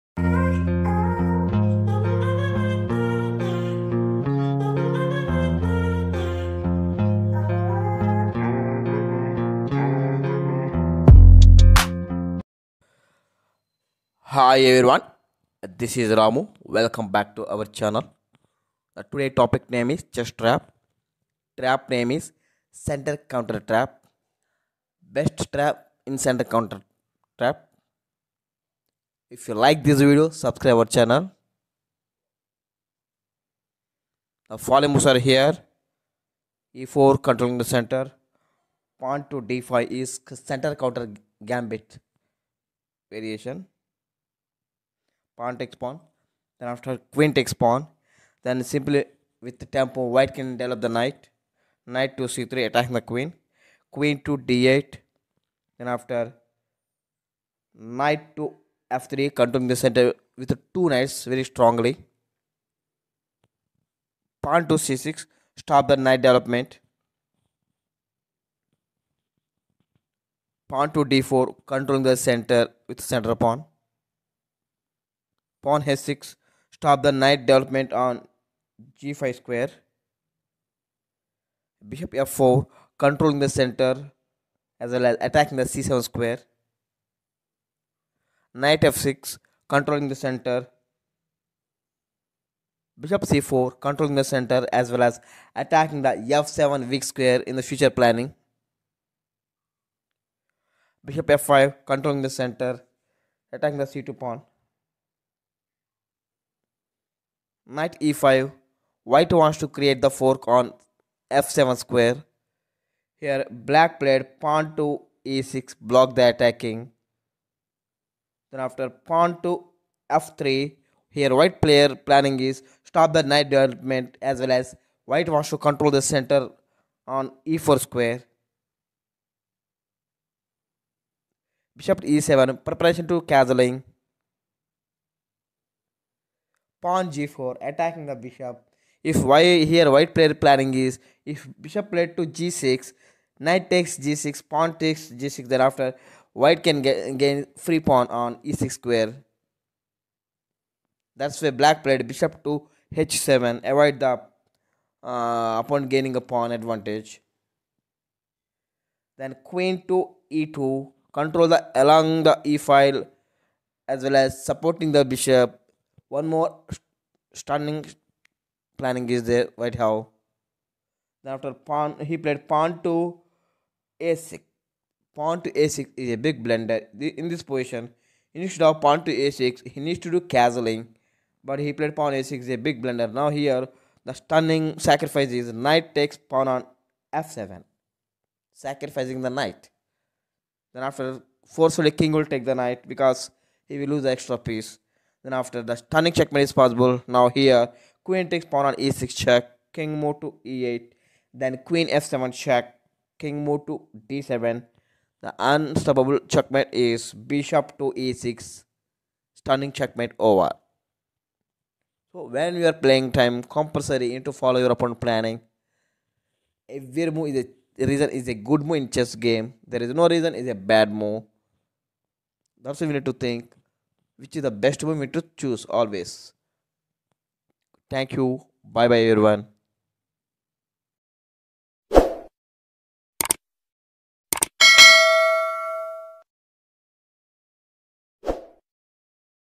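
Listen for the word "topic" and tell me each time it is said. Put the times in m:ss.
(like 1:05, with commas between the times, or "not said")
0:19.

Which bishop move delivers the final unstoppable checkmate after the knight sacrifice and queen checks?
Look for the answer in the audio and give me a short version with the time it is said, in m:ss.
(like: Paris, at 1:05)
Bishop to e6, at 3:27.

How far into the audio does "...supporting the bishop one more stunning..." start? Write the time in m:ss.
2:44.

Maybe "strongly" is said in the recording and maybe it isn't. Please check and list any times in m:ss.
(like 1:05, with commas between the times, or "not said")
1:01.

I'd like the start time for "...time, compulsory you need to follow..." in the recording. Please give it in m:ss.
3:33.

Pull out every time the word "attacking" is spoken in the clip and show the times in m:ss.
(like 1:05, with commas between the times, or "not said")
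0:52, 1:25, 1:35, 1:43, 1:56, 2:17.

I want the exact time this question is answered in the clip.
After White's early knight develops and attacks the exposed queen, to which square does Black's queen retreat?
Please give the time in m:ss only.
0:53.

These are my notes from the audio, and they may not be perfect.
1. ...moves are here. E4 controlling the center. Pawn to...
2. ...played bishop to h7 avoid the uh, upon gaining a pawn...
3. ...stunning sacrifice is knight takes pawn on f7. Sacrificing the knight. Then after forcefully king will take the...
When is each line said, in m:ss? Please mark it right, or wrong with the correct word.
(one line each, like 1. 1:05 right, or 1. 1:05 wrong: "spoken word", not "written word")
1. 0:34 right
2. 2:31 right
3. 3:04 right.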